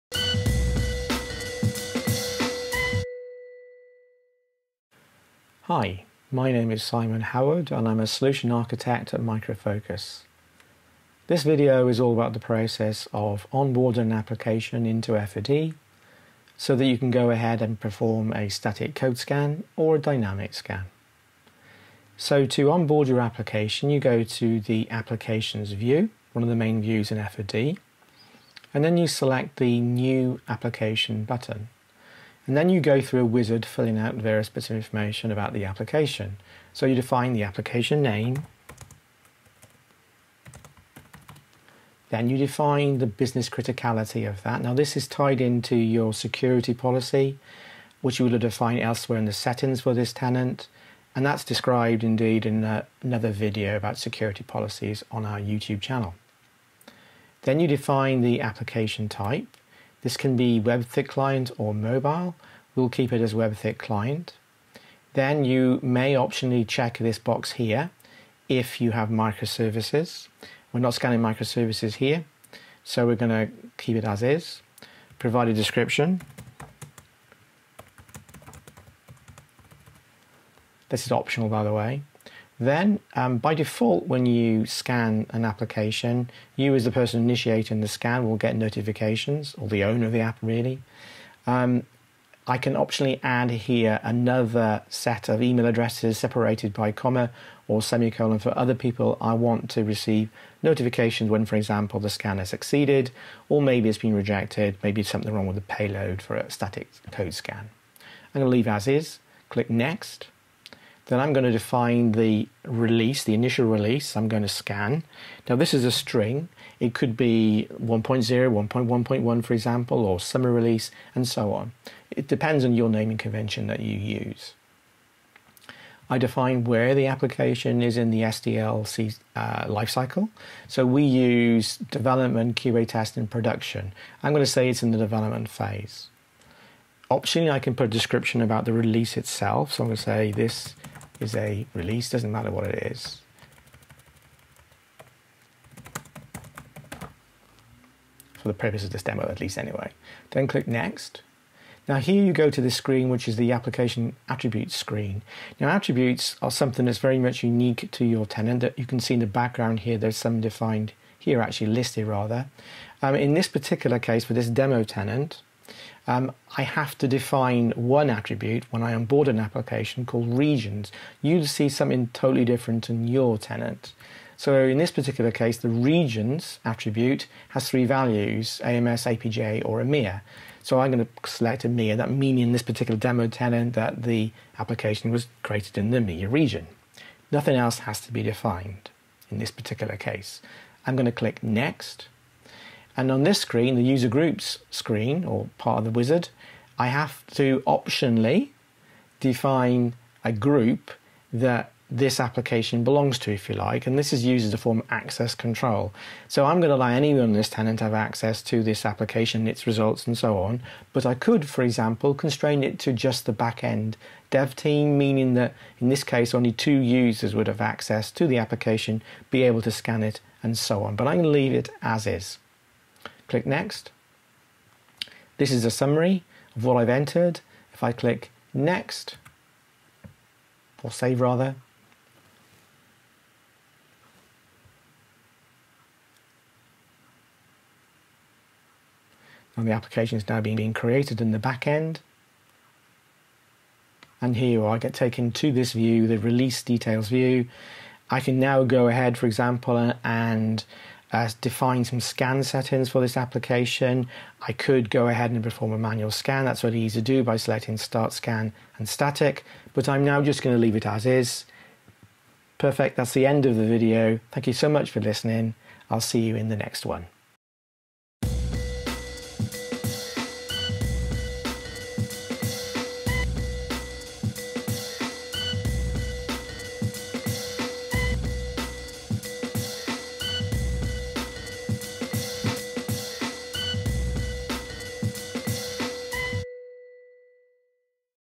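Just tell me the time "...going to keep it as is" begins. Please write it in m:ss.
1:13.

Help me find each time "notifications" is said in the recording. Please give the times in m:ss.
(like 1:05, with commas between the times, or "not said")
1:28, 1:40.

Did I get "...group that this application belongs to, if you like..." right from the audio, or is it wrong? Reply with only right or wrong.
right.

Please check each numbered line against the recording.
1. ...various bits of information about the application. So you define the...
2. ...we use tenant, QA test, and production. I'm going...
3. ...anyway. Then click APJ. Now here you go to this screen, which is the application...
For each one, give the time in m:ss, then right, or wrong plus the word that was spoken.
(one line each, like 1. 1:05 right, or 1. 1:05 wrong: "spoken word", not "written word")
1. 0:34 right
2. 2:10 wrong: "development", not "tenant"
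3. 2:29 wrong: "Next", not "APJ".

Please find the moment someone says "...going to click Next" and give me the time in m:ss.
3:10.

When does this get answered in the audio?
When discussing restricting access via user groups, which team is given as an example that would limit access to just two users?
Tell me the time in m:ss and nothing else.
3:33.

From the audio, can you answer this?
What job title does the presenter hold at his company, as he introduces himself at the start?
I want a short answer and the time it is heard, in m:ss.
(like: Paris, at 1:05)
Solution architect, at 0:08.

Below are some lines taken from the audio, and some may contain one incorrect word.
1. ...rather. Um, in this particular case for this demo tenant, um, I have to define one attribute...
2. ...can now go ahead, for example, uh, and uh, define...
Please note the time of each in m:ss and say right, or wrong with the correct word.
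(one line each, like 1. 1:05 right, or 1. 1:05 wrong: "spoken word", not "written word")
1. 2:42 right
2. 4:08 right.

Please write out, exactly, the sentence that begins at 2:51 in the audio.
You'd see something totally different in your tenant.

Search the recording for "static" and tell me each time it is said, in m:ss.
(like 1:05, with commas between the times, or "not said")
0:18, 1:46, 4:18.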